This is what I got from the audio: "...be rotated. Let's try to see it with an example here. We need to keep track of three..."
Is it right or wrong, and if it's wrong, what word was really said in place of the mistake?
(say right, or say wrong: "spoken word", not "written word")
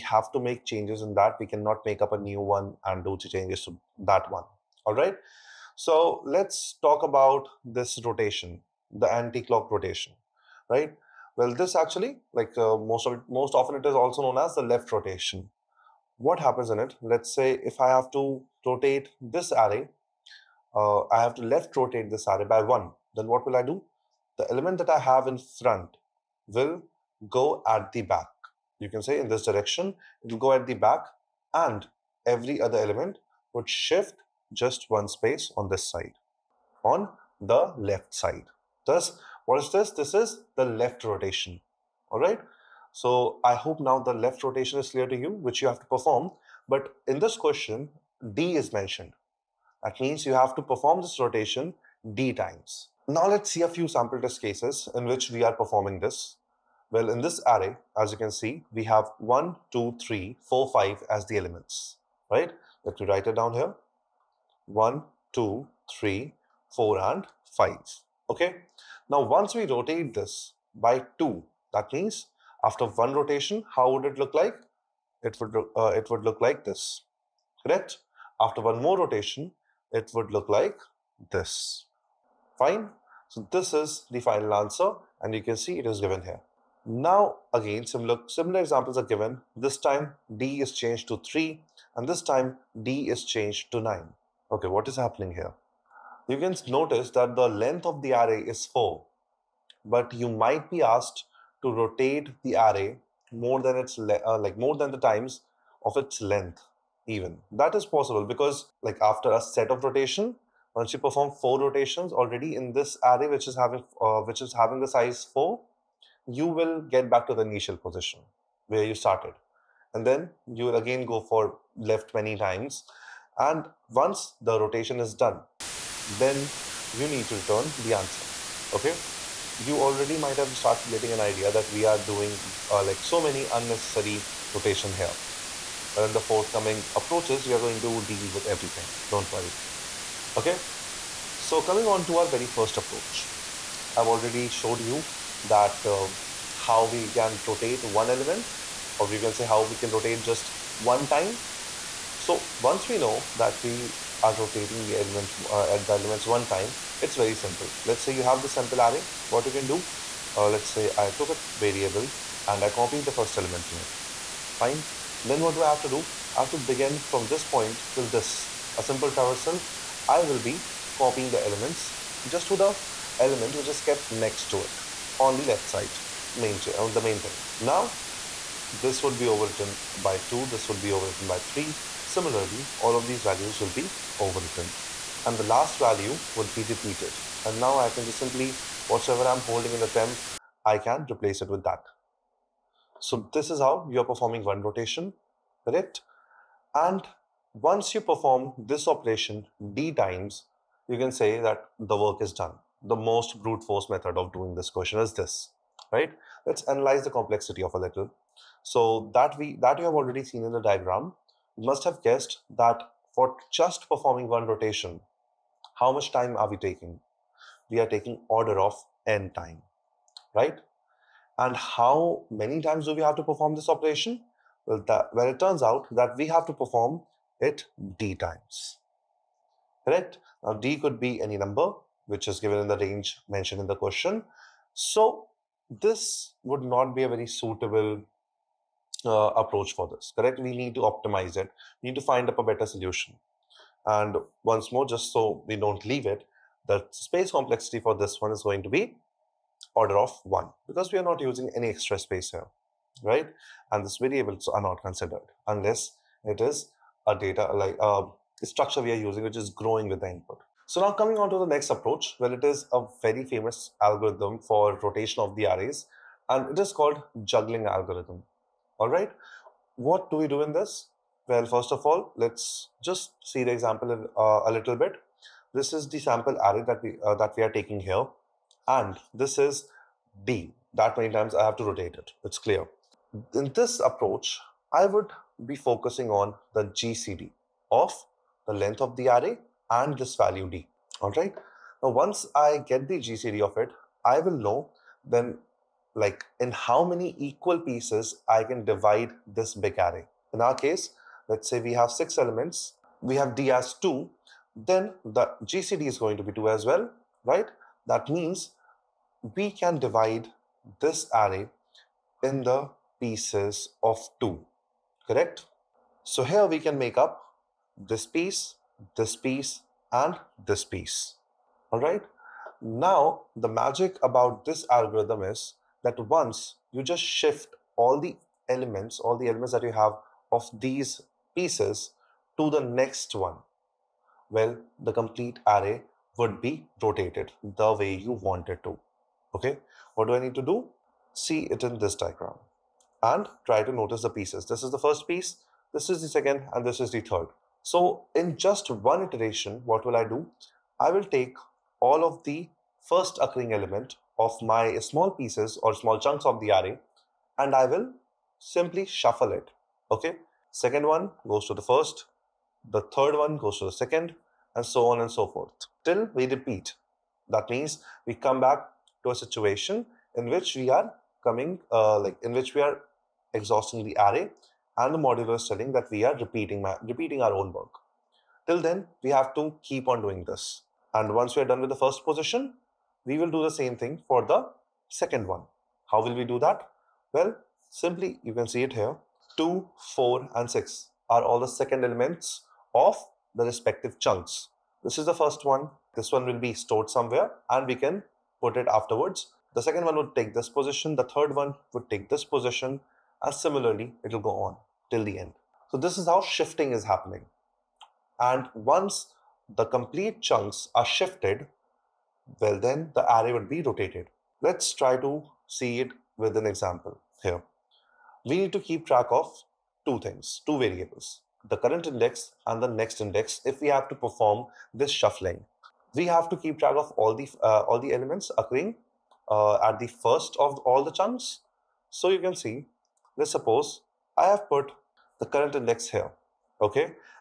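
wrong: "two", not "three".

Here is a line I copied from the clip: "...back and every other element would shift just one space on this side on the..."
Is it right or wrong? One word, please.
right.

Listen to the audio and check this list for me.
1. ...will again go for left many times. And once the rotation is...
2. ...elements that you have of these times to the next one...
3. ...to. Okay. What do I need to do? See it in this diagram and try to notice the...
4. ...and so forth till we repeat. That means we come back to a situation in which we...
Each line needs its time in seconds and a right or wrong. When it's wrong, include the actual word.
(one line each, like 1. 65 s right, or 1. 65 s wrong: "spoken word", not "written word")
1. 120 s right
2. 329 s wrong: "pieces", not "times"
3. 338 s right
4. 364 s right.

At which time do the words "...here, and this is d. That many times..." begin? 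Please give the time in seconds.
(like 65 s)
277 s.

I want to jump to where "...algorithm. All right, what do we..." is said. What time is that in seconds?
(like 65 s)
267 s.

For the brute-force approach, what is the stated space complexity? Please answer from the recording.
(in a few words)
order of 1.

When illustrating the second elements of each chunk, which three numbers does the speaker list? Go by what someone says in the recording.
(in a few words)
2, 4 and 6.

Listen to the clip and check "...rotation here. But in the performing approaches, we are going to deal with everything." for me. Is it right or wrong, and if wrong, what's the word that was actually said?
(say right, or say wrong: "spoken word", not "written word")
wrong: "forthcoming", not "performing".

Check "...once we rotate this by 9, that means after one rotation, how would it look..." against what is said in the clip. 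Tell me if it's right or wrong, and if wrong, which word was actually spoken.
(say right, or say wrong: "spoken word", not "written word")
wrong: "2", not "9".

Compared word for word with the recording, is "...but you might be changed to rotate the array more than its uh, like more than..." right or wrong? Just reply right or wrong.
wrong.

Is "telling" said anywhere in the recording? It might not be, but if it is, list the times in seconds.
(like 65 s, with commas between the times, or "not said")
375 s.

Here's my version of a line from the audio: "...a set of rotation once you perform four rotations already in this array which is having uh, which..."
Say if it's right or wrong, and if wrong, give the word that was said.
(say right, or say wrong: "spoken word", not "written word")
right.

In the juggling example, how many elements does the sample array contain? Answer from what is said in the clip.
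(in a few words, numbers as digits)
6.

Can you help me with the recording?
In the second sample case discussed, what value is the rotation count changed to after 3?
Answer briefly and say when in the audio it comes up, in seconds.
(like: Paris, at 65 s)
9, at 92 s.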